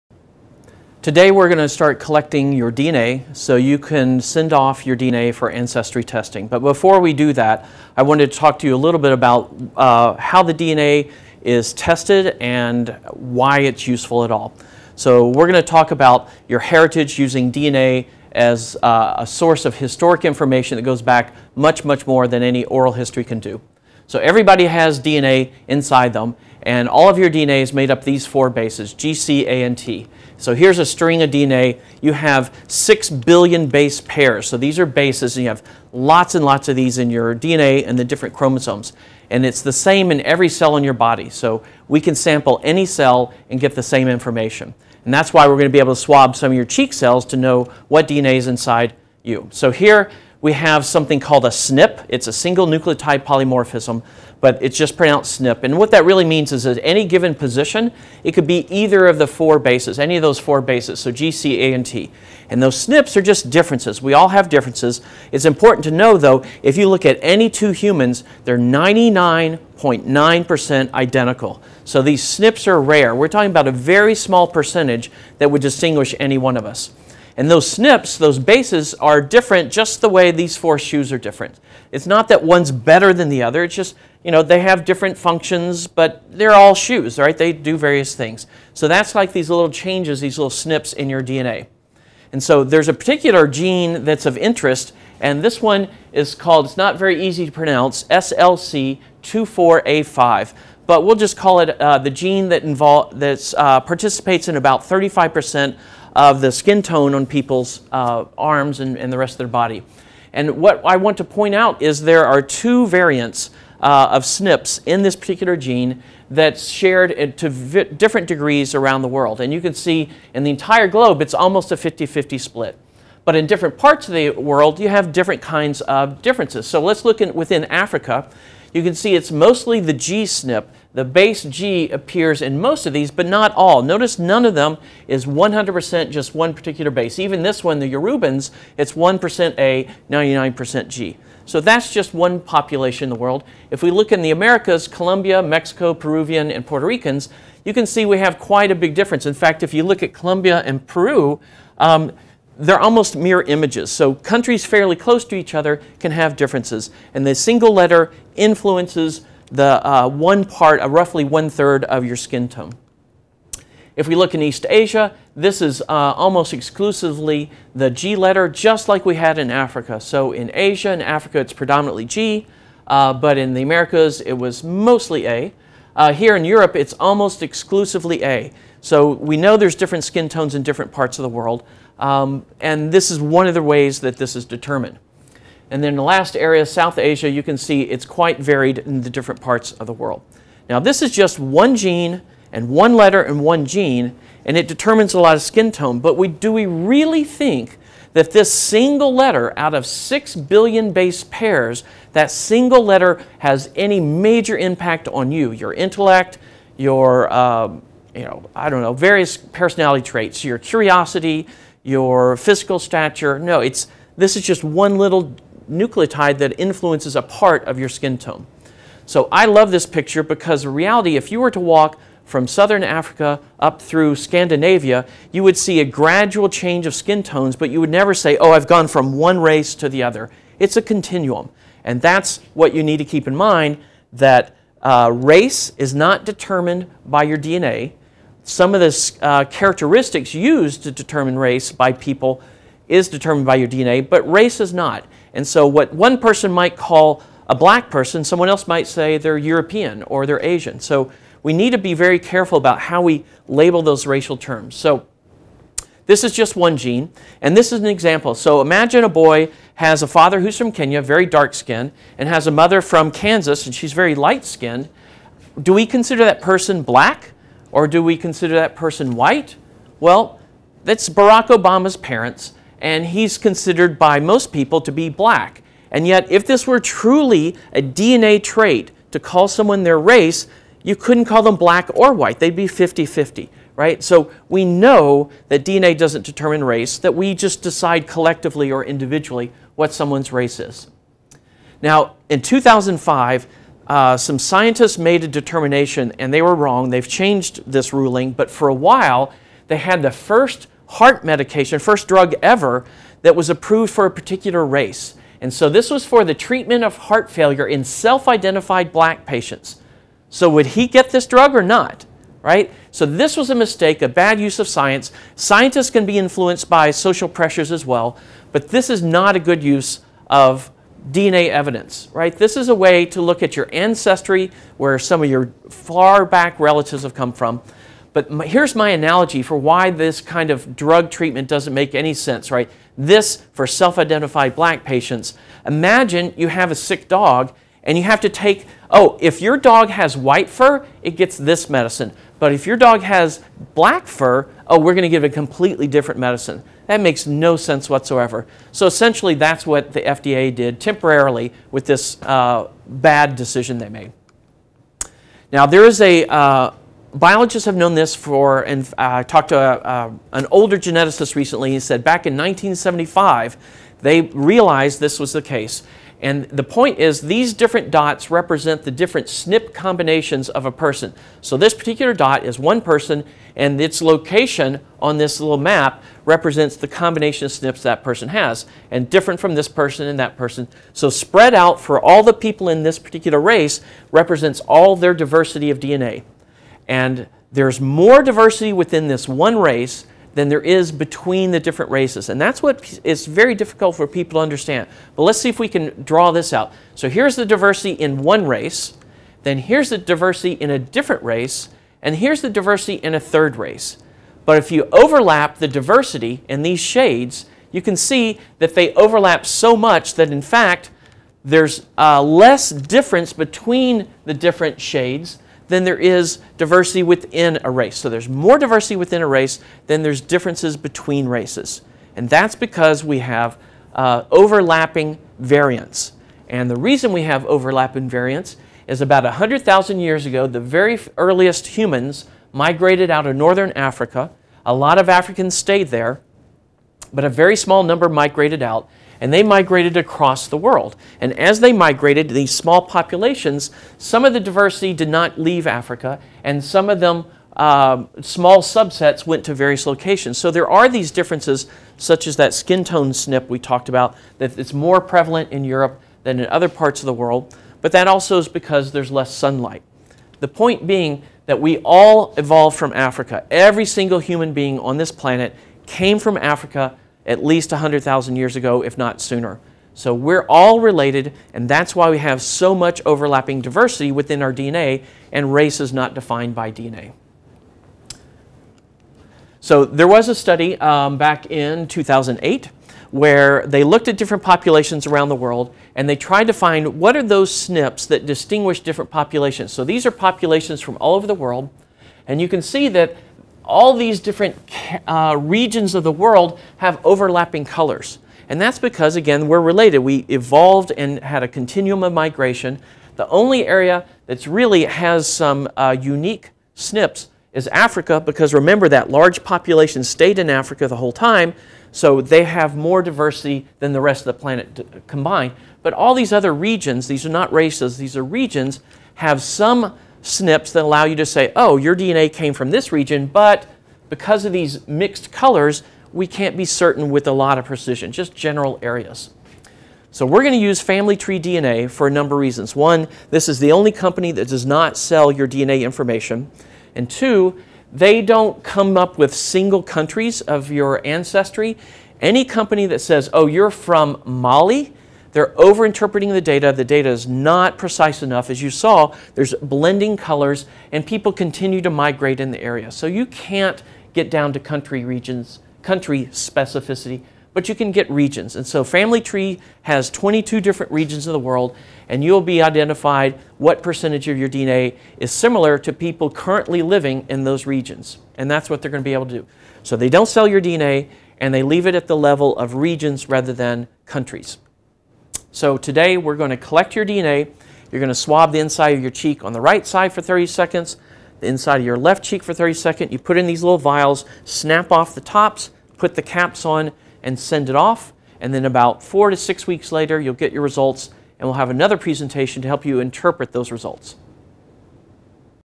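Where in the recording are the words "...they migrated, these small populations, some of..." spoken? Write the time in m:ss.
7:21.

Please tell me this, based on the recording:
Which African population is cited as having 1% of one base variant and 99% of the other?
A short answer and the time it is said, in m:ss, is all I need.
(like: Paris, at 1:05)
Yorubans, at 2:17.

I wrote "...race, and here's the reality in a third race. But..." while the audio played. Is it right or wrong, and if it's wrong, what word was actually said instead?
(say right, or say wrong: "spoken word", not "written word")
wrong: "diversity", not "reality".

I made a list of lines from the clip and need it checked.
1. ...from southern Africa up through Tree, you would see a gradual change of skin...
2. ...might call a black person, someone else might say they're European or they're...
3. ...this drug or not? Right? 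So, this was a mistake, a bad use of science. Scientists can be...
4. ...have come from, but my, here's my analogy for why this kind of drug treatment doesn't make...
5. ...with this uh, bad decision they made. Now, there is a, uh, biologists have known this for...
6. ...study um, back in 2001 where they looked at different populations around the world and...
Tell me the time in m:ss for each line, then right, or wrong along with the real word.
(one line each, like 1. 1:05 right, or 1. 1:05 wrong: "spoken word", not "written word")
1. 3:42 wrong: "Scandinavia", not "Tree"
2. 4:06 right
3. 5:11 right
4. 5:27 right
5. 5:51 right
6. 8:00 wrong: "2008", not "2001".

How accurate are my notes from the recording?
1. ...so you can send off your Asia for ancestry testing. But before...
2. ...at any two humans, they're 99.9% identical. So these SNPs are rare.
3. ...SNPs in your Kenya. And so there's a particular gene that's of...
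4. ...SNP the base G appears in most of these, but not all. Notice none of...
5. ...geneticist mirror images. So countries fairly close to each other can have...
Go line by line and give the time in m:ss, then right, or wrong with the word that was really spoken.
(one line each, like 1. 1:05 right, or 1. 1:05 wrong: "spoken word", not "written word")
1. 0:03 wrong: "DNA", not "Asia"
2. 1:07 right
3. 1:30 wrong: "DNA", not "Kenya"
4. 2:10 right
5. 2:32 wrong: "almost", not "geneticist".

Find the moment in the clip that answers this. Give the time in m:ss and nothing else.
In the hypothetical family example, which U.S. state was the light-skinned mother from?
4:23.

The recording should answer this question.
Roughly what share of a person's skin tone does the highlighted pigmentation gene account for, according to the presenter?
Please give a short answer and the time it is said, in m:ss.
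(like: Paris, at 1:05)
35%, at 1:44.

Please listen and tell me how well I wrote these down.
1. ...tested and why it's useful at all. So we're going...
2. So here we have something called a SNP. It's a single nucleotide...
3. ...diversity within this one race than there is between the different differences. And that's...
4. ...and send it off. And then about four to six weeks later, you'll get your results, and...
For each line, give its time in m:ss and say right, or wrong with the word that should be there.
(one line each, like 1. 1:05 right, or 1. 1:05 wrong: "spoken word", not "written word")
1. 0:11 right
2. 0:49 right
3. 6:28 wrong: "races", not "differences"
4. 9:47 right.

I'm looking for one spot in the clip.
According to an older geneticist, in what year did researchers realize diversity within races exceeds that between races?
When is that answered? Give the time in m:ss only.
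6:02.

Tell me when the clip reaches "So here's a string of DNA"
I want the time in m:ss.
0:30.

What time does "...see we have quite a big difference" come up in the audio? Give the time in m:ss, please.
2:27.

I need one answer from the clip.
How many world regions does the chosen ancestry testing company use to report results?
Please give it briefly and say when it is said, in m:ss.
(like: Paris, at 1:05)
22, at 9:20.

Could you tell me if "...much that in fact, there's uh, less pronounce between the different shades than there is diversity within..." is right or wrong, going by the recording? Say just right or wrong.
wrong.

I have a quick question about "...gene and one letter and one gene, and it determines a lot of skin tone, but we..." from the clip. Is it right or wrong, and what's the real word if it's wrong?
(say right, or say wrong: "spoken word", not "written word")
right.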